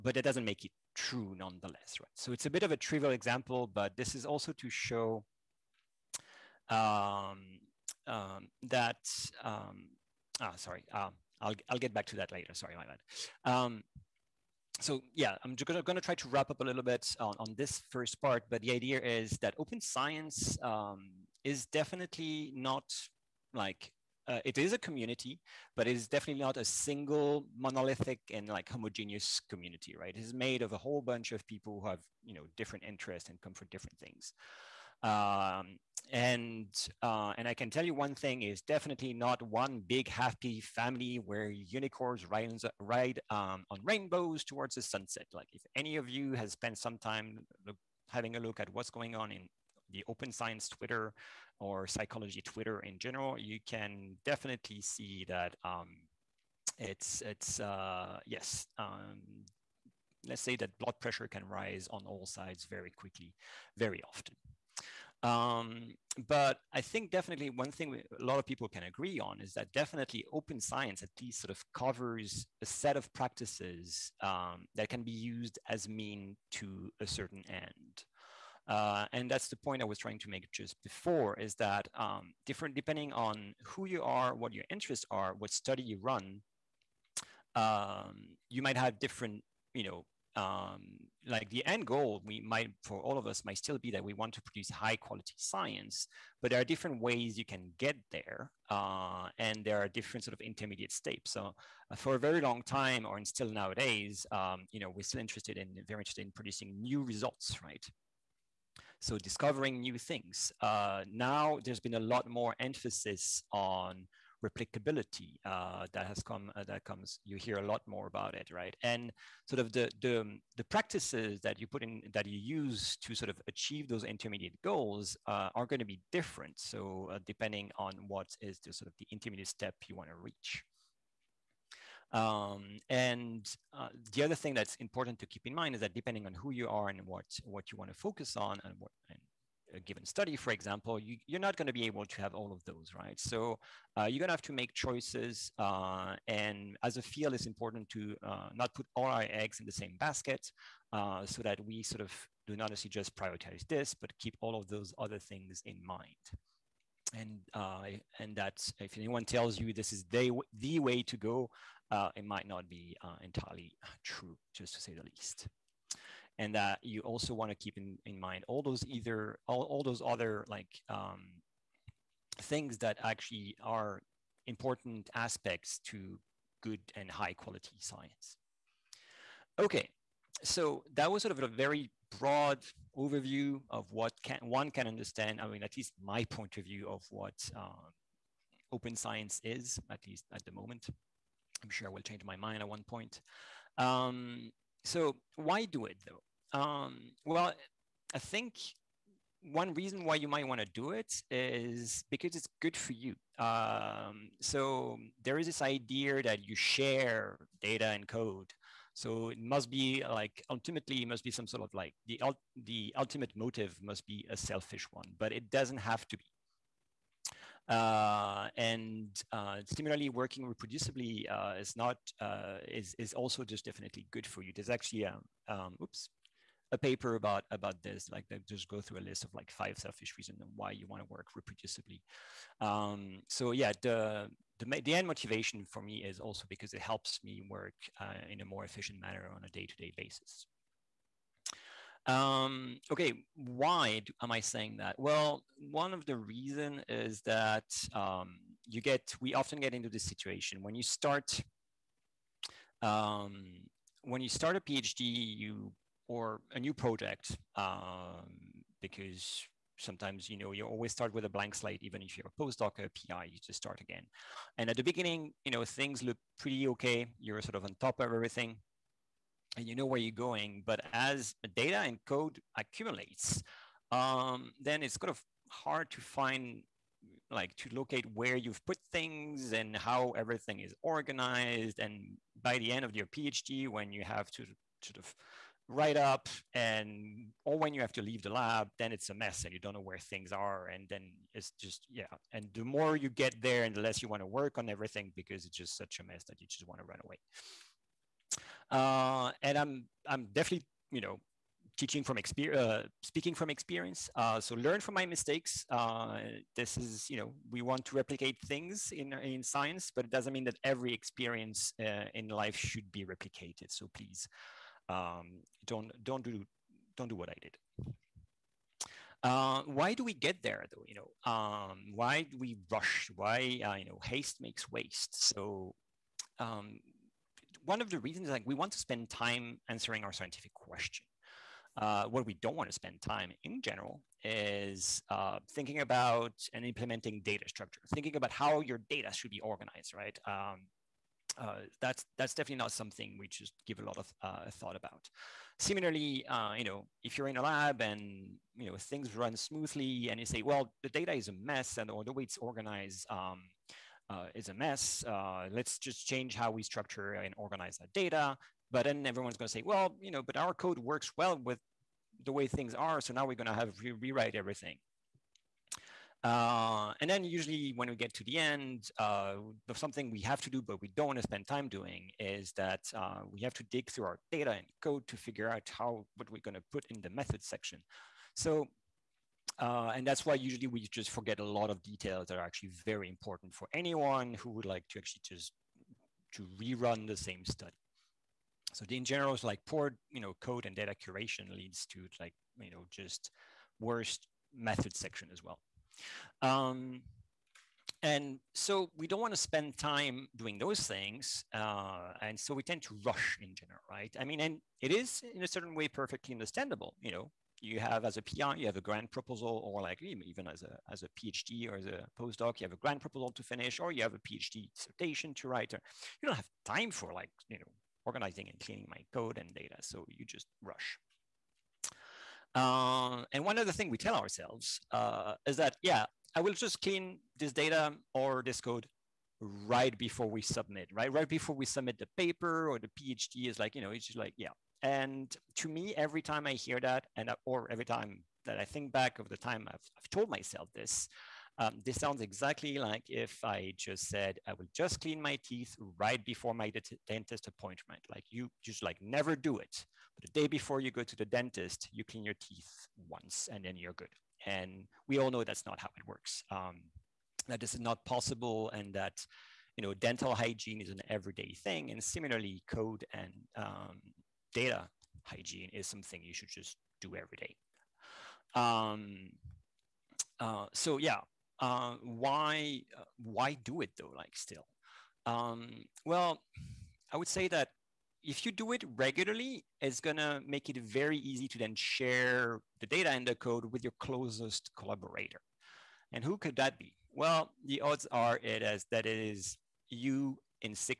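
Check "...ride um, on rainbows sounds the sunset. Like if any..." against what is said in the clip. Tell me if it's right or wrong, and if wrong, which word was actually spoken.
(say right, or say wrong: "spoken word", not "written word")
wrong: "towards", not "sounds".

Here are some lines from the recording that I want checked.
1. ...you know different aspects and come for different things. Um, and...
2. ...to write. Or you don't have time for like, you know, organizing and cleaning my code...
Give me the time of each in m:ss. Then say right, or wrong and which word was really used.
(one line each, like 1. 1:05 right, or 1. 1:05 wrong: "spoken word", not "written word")
1. 0:32 wrong: "interests", not "aspects"
2. 6:55 right.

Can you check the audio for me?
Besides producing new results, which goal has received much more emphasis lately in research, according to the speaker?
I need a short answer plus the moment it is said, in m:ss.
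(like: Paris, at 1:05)
replicability, at 1:54.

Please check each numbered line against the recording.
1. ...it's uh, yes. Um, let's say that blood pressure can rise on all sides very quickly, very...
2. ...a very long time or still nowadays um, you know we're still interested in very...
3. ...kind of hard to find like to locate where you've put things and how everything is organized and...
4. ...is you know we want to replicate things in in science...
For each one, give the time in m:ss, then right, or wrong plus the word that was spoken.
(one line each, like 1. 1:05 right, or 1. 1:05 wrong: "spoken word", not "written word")
1. 0:57 right
2. 1:42 right
3. 4:34 right
4. 5:06 right.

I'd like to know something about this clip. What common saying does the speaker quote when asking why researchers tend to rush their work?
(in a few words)
haste makes waste.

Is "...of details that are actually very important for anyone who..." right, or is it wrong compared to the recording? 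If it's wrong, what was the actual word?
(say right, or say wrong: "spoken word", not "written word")
right.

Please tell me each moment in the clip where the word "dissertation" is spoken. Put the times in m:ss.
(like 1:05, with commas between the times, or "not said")
6:54.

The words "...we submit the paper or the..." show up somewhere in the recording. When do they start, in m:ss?
7:11.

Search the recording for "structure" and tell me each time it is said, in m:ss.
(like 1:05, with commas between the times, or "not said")
5:37, 5:56.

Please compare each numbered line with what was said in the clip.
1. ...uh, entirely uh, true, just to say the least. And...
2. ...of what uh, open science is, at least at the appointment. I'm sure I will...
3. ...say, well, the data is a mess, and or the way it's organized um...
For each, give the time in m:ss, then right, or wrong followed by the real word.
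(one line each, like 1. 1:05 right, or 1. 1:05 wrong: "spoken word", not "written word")
1. 2:43 right
2. 3:06 wrong: "moment", not "appointment"
3. 5:50 right.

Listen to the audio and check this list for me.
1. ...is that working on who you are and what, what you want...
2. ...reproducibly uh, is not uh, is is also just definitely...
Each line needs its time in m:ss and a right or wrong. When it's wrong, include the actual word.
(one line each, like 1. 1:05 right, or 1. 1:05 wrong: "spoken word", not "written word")
1. 2:15 wrong: "depending", not "working"
2. 3:40 right.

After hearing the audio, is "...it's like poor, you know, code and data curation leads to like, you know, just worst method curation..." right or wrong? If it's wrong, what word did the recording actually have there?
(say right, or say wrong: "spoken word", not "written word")
wrong: "section", not "curation".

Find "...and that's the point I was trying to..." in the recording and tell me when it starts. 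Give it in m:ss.
1:19.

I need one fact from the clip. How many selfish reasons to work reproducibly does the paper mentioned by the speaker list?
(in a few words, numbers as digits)
5.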